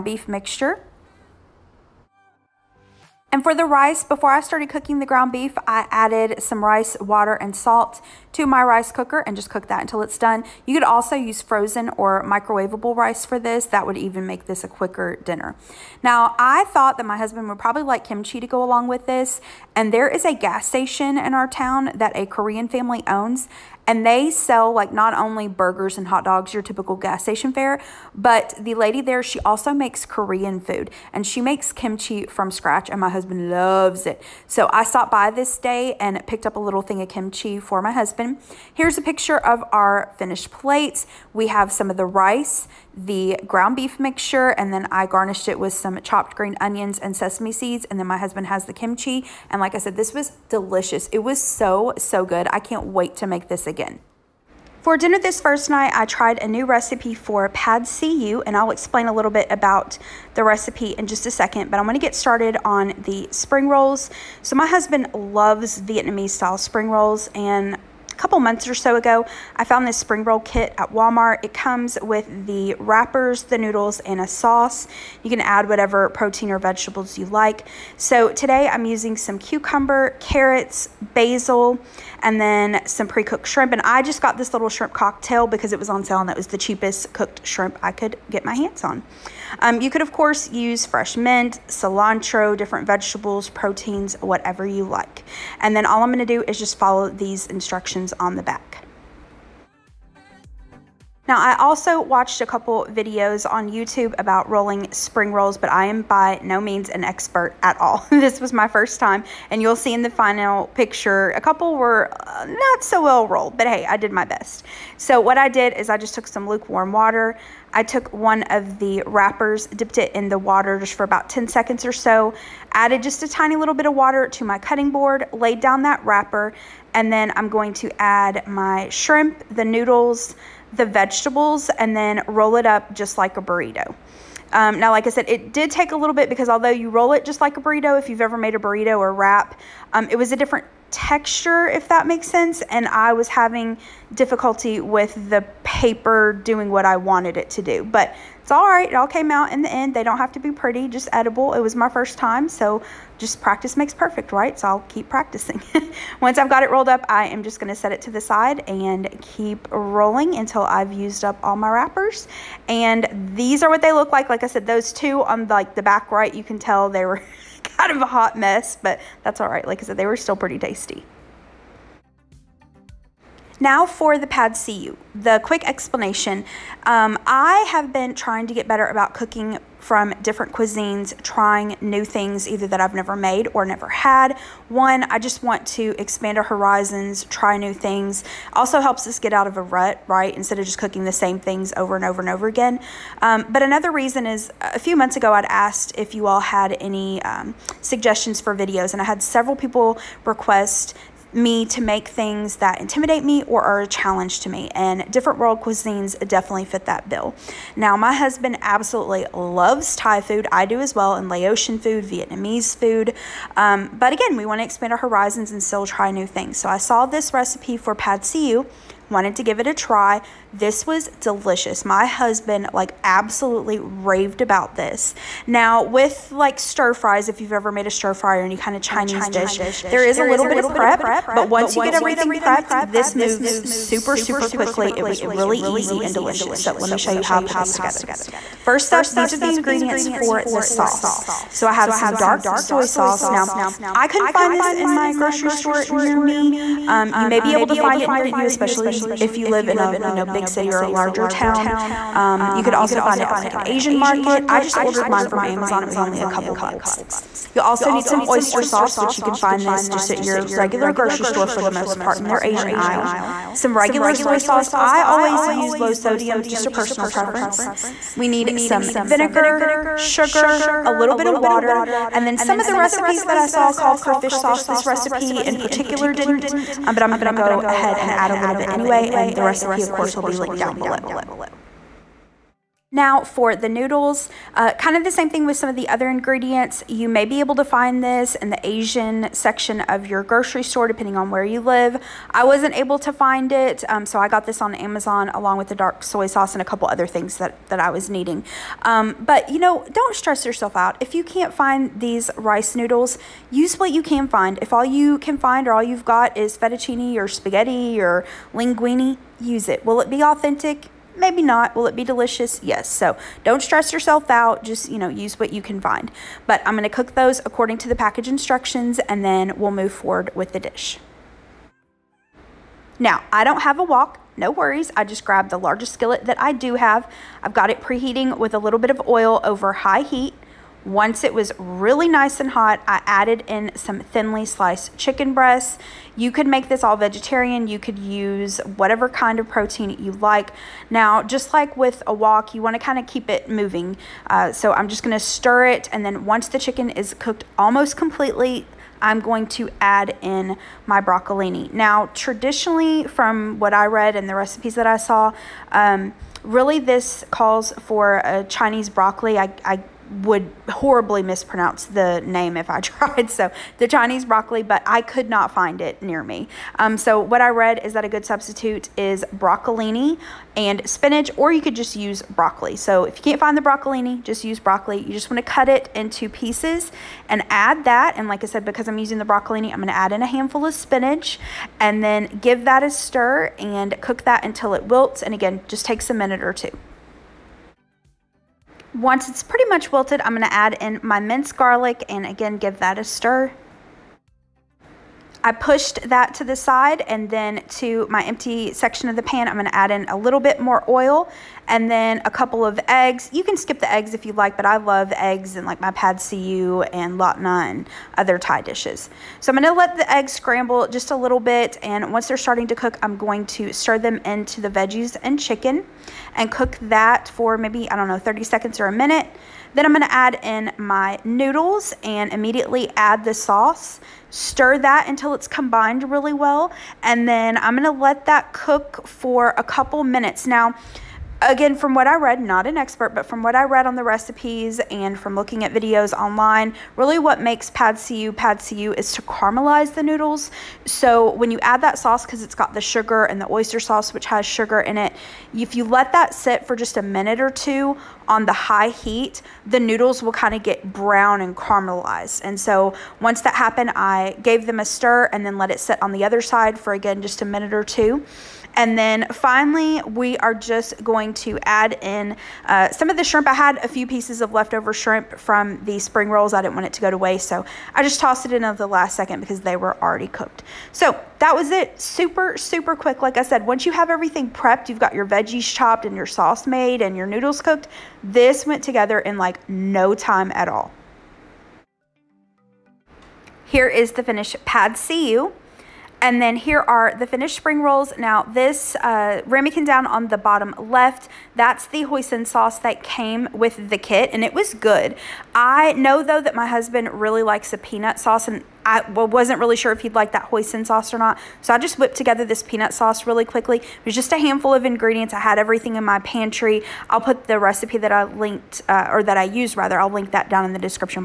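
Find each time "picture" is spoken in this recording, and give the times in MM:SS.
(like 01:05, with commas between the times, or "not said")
00:39, 01:50.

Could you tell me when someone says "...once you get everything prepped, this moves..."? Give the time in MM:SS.
03:51.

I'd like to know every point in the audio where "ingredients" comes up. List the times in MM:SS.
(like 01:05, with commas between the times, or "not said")
03:59, 04:46, 08:24.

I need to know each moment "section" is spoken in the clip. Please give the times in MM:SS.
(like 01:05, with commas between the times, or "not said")
04:49, 06:38.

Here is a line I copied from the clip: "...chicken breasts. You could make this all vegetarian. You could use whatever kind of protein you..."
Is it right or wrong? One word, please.
right.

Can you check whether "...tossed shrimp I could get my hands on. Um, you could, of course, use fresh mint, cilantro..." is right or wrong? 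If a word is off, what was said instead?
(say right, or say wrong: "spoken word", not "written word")
wrong: "cooked", not "tossed".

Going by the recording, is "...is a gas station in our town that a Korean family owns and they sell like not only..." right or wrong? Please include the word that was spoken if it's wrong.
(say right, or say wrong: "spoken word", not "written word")
right.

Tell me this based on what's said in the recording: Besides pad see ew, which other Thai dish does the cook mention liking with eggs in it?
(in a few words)
lad na.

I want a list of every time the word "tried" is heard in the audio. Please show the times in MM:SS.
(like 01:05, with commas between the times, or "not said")
00:56, 06:02.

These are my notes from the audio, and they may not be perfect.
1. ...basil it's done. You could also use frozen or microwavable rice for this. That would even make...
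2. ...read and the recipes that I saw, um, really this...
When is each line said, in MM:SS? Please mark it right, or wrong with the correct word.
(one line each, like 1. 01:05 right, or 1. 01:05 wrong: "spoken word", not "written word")
1. 00:09 wrong: "until", not "basil"
2. 05:53 right.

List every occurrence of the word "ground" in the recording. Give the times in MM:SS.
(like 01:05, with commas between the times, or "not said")
00:05, 00:43.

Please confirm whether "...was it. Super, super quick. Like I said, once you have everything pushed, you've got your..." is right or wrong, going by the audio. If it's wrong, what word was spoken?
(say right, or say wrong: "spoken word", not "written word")
wrong: "prepped", not "pushed".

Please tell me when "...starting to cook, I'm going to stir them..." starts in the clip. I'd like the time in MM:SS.
06:52.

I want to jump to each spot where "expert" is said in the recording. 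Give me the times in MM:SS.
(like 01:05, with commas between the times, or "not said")
01:47, 07:12.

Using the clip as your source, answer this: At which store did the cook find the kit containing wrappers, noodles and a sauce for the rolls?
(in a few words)
Walmart.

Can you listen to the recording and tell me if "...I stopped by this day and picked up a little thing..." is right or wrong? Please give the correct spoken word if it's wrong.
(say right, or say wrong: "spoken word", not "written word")
right.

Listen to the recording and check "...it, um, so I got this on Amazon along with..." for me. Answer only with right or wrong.
right.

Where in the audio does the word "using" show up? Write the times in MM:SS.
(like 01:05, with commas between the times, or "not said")
01:18, 06:18.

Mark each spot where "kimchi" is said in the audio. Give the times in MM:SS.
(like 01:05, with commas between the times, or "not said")
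00:18, 00:31, 00:37, 00:48.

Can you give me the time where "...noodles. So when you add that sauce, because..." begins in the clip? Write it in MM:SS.
07:20.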